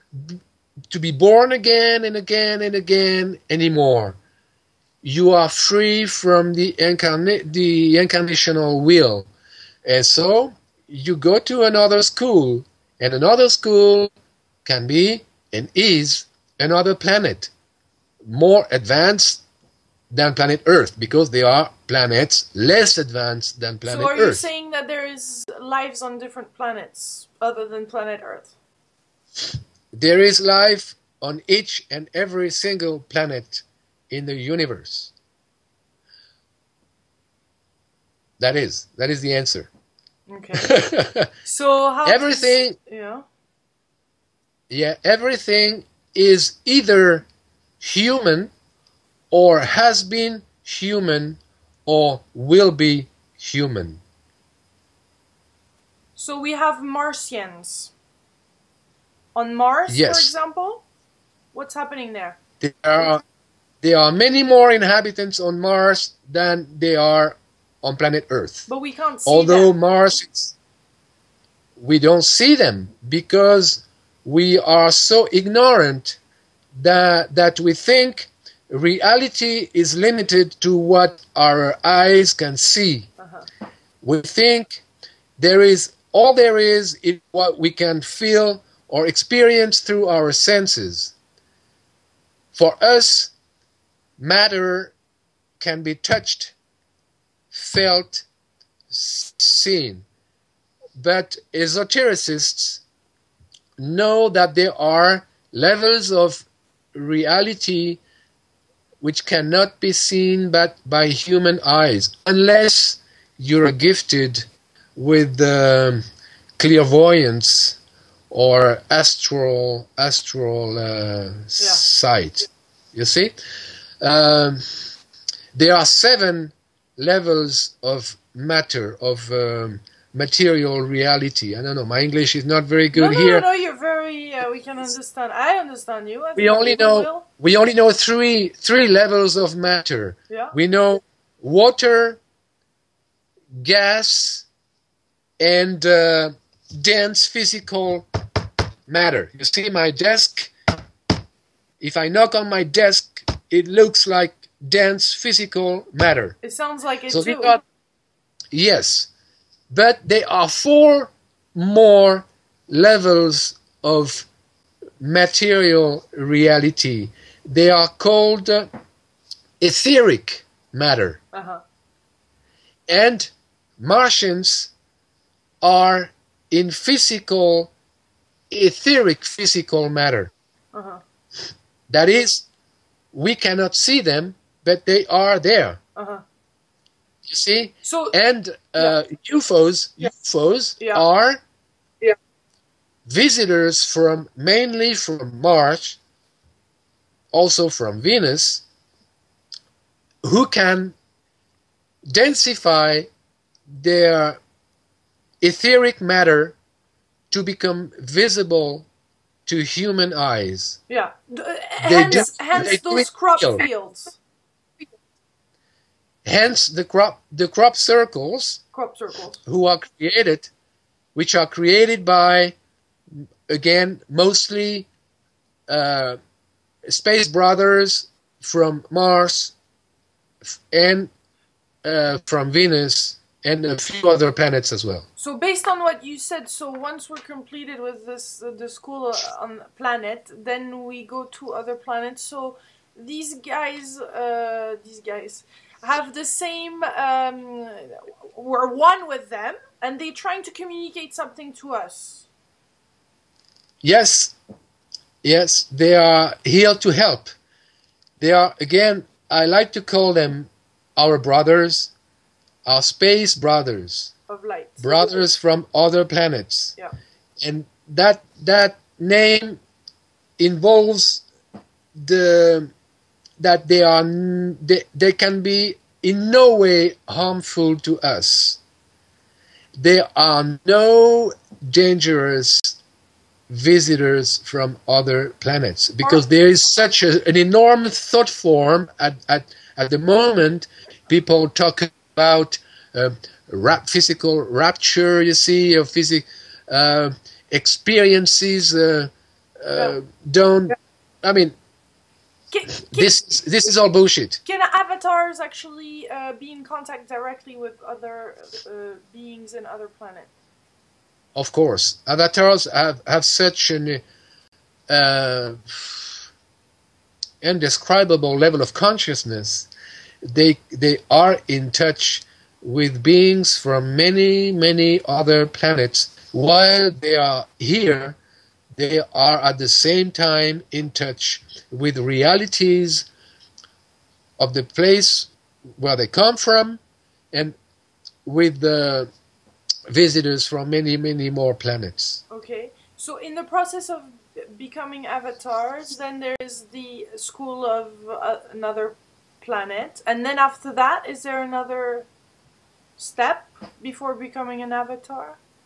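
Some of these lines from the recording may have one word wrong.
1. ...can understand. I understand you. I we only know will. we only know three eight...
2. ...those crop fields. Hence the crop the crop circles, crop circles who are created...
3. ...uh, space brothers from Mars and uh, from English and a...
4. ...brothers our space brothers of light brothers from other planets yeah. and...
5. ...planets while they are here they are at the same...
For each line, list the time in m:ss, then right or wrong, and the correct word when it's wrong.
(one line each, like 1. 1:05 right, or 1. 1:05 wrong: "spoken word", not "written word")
1. 2:14 wrong: "three", not "eight"
2. 3:32 right
3. 3:45 wrong: "Venus", not "English"
4. 4:21 right
5. 5:25 right.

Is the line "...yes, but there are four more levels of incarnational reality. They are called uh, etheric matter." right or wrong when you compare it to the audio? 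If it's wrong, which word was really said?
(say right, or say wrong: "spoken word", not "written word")
wrong: "material", not "incarnational".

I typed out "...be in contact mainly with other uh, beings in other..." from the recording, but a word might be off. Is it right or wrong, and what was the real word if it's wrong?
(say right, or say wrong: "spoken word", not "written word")
wrong: "directly", not "mainly".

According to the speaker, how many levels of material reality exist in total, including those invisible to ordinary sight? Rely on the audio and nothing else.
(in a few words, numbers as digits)
7.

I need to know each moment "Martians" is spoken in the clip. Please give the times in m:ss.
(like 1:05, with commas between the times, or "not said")
0:56, 2:53.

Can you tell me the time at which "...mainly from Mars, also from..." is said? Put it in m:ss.
3:14.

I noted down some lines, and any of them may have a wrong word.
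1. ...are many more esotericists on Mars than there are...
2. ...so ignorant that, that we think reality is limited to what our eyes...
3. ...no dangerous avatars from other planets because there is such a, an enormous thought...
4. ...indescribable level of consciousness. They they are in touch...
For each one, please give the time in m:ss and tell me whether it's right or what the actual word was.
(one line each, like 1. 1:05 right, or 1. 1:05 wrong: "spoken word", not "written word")
1. 1:03 wrong: "inhabitants", not "esotericists"
2. 1:14 right
3. 4:40 wrong: "visitors", not "avatars"
4. 5:17 right.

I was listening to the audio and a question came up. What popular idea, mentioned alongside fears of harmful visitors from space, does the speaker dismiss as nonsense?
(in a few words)
Physical rapture.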